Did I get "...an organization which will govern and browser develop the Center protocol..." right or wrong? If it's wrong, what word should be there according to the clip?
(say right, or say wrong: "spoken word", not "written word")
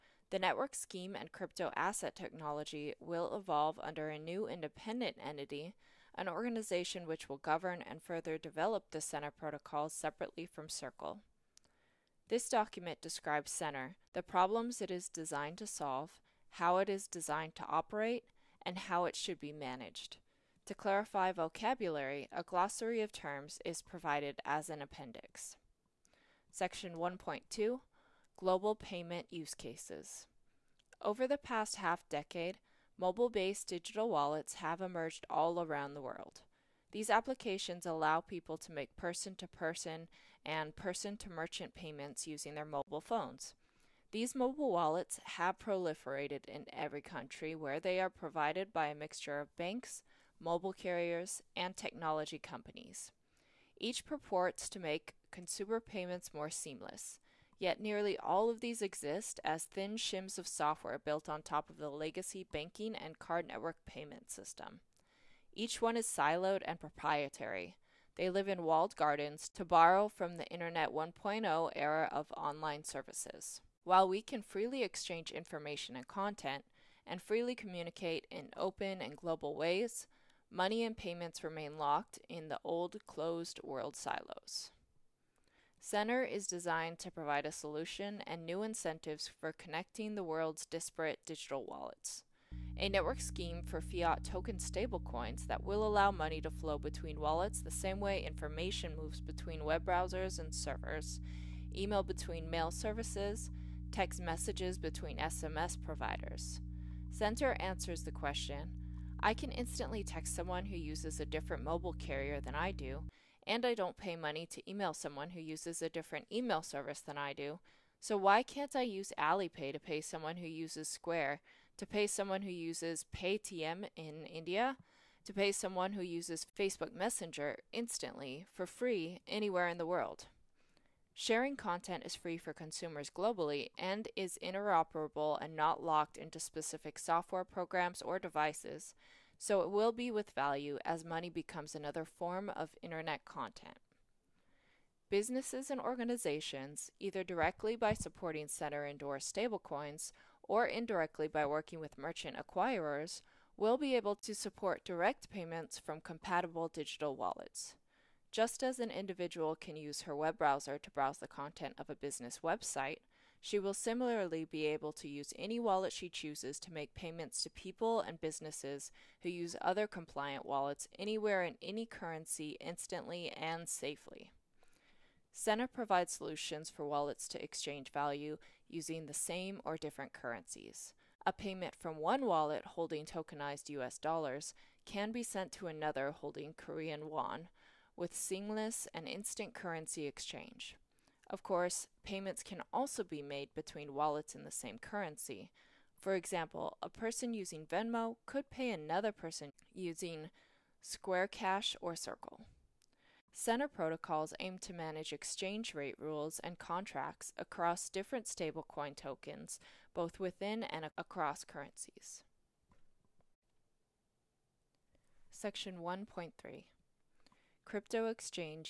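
wrong: "further", not "browser".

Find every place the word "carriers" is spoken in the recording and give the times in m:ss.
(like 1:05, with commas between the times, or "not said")
0:50, 1:51.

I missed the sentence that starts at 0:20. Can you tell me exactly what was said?
To clarify vocabulary, a glossary of terms is provided as an appendix.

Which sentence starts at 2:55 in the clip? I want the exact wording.
Center provides solutions for wallets to exchange value using the same or different currencies.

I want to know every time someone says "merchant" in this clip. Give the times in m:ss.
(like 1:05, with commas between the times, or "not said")
0:41, 2:31.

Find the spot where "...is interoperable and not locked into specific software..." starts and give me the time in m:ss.
2:14.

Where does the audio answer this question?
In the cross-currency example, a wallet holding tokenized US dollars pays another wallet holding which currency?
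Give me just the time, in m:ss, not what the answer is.
3:06.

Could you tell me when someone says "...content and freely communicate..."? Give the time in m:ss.
1:16.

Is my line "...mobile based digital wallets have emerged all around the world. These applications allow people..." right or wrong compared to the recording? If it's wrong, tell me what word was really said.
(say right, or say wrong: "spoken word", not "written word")
right.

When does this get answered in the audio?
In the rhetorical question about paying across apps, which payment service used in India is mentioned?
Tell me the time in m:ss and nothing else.
2:03.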